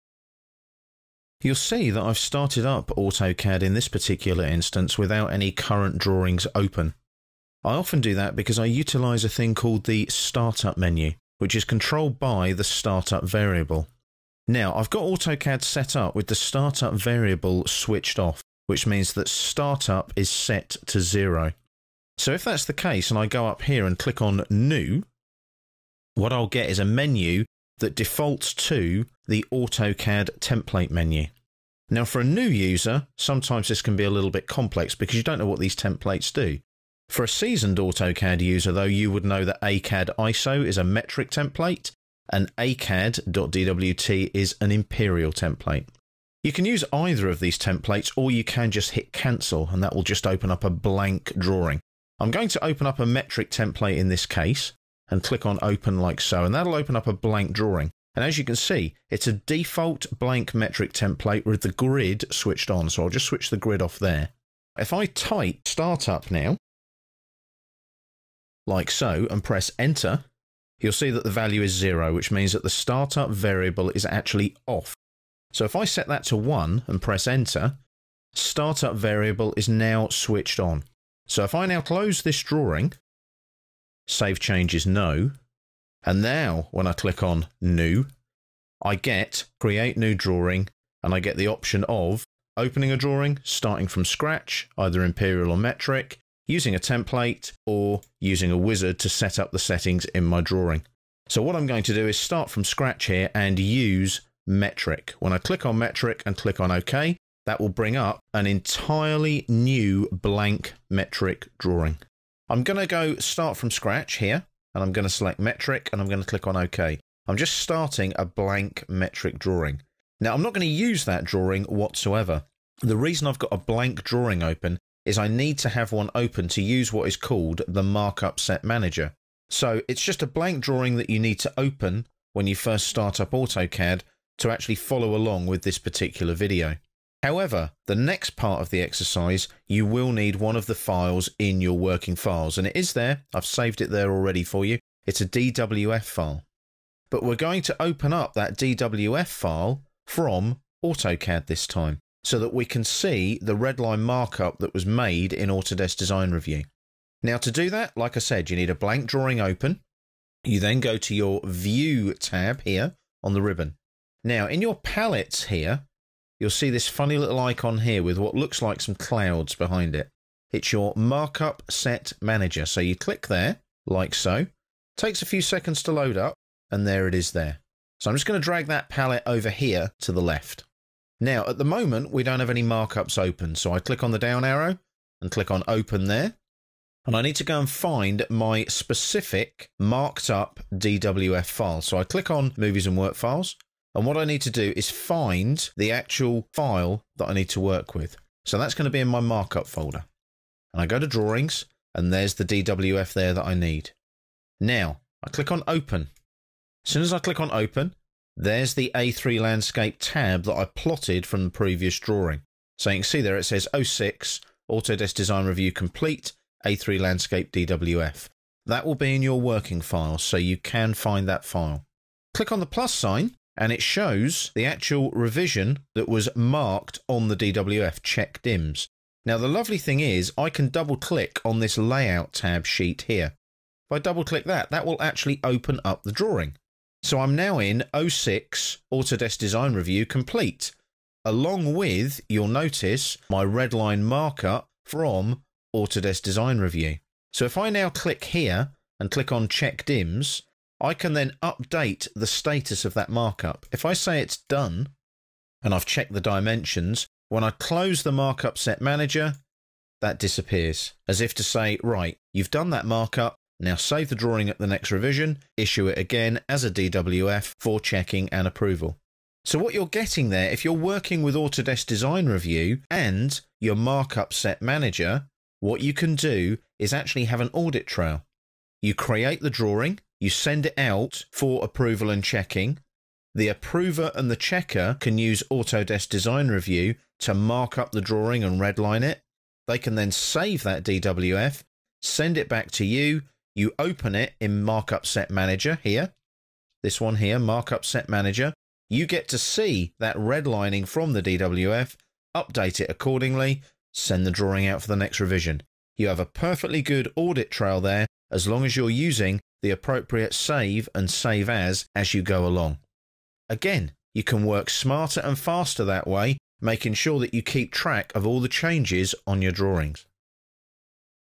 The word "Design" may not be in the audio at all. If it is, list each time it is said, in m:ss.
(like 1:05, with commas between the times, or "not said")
2:35, 3:35, 3:59, 4:06, 4:31, 4:46.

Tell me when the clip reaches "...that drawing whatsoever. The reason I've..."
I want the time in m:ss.
2:01.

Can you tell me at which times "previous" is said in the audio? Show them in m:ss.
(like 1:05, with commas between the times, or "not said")
3:31.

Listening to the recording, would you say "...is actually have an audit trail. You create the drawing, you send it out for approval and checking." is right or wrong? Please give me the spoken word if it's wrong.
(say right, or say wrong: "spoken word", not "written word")
right.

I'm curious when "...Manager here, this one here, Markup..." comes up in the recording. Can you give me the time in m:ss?
4:55.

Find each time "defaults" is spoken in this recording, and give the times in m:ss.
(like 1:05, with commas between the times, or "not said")
0:27, 0:59.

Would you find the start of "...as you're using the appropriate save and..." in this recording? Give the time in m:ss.
5:08.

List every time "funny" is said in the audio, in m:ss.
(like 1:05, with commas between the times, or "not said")
2:46.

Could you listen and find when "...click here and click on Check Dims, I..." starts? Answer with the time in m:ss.
4:07.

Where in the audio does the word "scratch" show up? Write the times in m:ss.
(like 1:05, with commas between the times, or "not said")
1:34, 1:42, 1:53.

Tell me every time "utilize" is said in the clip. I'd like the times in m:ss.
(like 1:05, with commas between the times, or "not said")
0:08.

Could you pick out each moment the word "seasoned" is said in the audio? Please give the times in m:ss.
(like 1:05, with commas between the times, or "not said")
0:37.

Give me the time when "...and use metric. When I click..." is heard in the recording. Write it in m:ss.
1:43.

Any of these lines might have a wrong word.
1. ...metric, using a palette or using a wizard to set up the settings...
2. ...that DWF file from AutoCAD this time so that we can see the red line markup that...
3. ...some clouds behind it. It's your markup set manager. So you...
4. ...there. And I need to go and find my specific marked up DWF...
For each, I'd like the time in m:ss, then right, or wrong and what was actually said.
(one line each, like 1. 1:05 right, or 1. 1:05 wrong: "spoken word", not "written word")
1. 1:35 wrong: "template", not "palette"
2. 2:28 right
3. 2:48 right
4. 3:06 right.